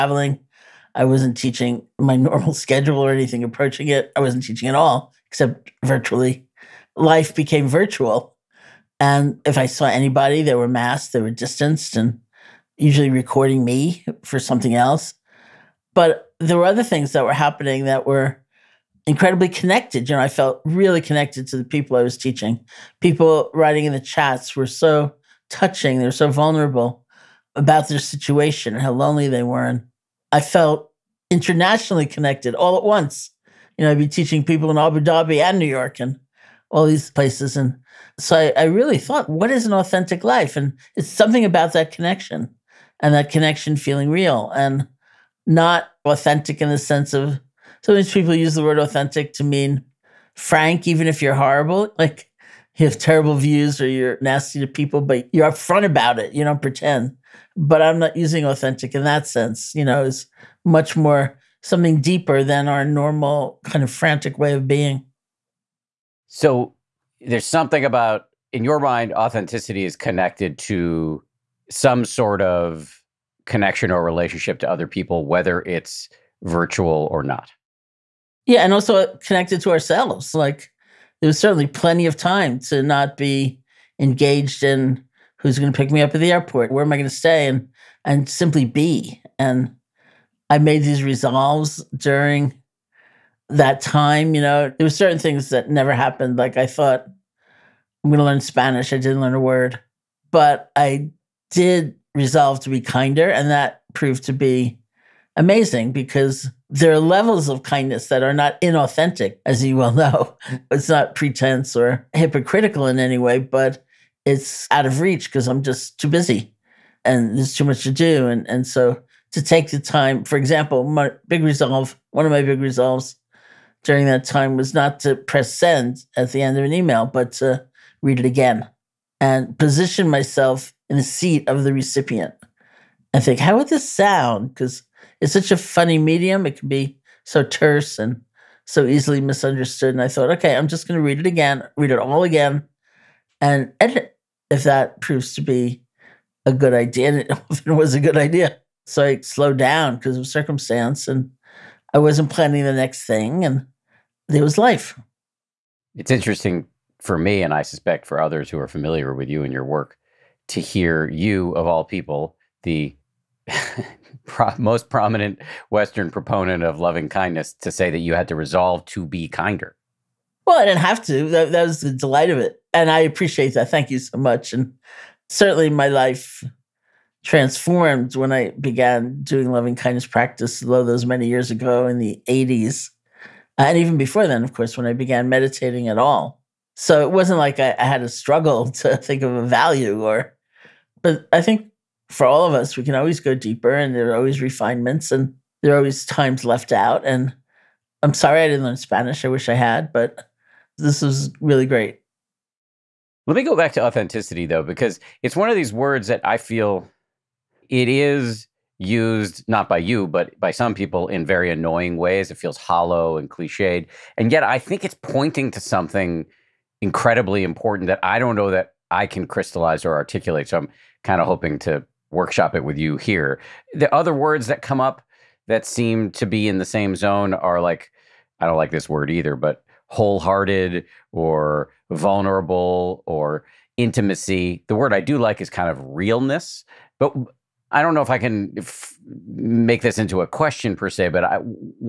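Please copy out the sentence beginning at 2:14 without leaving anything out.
Because it's such a funny medium.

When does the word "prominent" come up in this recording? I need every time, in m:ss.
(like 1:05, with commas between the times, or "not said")
2:44.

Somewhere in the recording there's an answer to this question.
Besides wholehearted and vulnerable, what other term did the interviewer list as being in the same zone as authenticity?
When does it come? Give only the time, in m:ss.
3:53.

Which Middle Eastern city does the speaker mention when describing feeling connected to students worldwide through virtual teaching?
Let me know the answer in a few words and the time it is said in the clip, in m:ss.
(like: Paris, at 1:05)
Abu Dhabi, at 0:34.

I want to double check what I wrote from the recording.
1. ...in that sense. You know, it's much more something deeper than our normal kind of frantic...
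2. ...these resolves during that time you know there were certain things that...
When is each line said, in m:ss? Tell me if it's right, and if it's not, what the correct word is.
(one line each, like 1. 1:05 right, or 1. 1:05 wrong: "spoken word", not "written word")
1. 0:58 right
2. 1:30 right.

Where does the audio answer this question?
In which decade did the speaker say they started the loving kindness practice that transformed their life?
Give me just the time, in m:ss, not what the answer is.
3:02.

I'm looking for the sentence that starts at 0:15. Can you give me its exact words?
But there were other things that were happening that were incredibly connected.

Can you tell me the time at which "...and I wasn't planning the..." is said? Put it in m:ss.
2:31.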